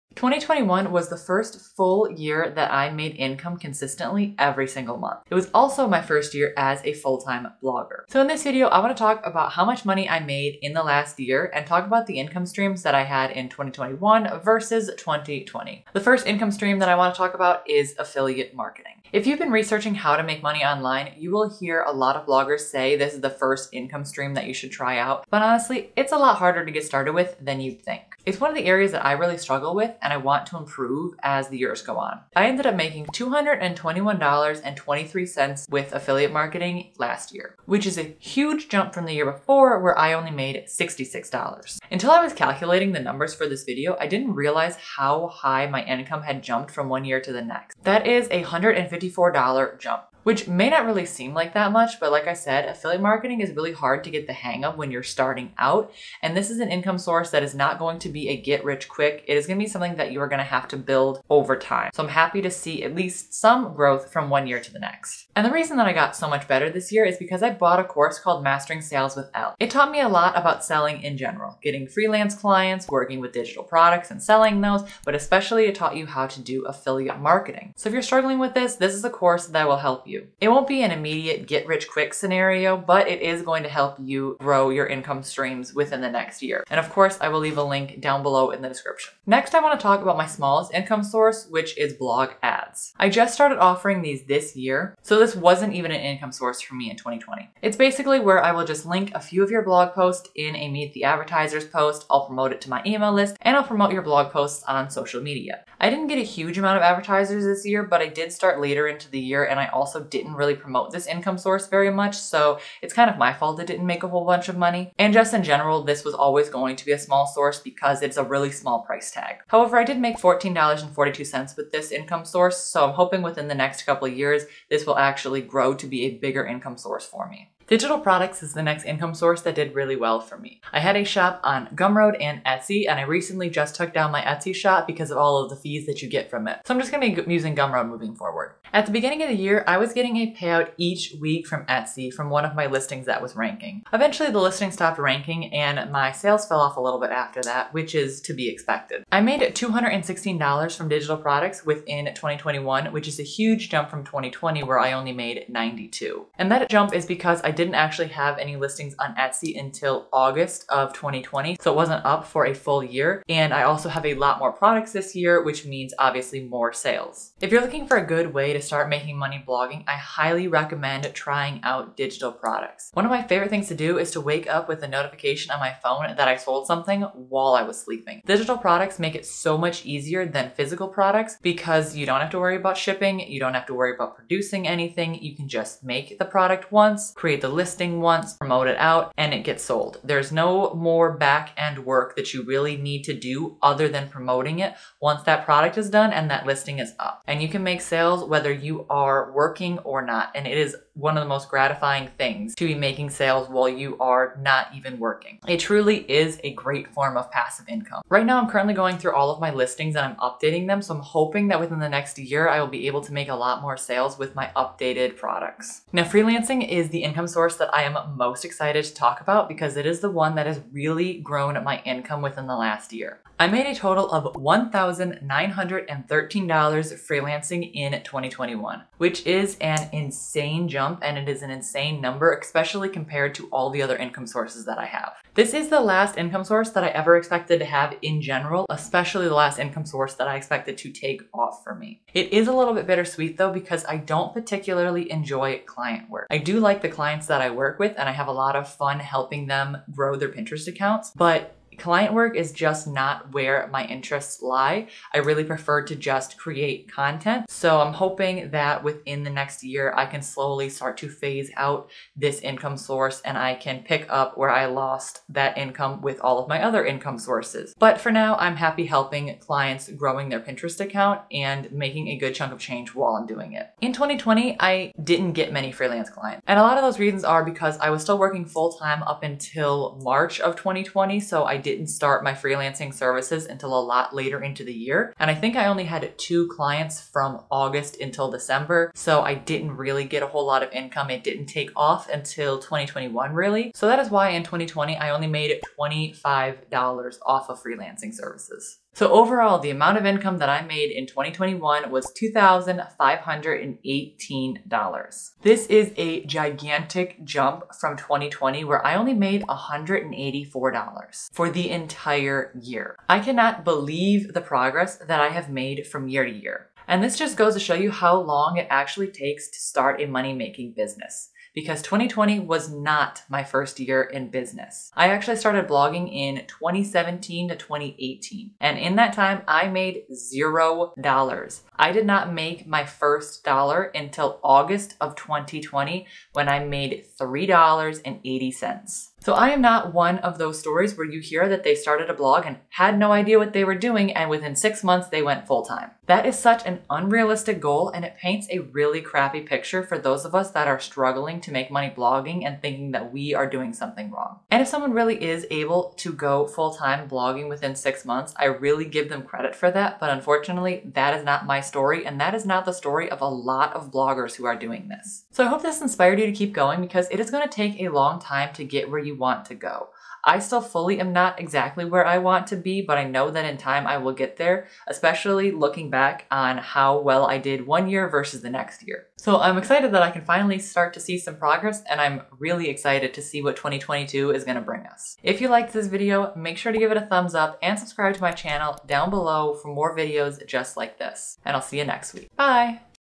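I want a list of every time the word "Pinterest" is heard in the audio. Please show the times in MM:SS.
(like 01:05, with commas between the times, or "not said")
04:10, 04:30.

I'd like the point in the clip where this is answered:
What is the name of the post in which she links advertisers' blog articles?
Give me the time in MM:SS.
01:40.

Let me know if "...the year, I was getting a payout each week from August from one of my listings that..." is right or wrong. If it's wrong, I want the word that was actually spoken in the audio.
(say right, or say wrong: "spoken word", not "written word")
wrong: "Etsy", not "August".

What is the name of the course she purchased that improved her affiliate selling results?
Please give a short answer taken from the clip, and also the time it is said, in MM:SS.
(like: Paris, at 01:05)
Mastering Sales with Elle, at 01:08.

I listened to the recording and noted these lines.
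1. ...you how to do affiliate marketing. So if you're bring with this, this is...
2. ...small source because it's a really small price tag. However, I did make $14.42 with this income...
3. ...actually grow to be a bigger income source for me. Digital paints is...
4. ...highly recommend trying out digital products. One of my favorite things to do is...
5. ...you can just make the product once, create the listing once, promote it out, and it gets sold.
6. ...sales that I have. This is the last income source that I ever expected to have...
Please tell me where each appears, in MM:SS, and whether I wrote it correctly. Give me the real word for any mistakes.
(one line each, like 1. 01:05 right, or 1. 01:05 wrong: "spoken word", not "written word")
1. 01:15 wrong: "struggling", not "bring"
2. 01:56 right
3. 02:04 wrong: "products", not "paints"
4. 02:49 right
5. 03:05 right
6. 03:54 wrong: "sources", not "sales".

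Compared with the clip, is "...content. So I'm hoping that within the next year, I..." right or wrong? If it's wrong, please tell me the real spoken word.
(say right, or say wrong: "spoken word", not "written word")
right.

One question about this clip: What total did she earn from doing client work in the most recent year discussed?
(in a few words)
$1,913.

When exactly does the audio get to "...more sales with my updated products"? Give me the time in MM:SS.
03:33.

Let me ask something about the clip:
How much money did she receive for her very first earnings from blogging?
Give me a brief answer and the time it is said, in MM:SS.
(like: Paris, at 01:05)
$3.80, at 05:37.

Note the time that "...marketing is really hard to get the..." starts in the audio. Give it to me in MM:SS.
00:53.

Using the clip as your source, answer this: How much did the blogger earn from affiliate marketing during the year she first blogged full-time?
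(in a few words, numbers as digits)
$221.23.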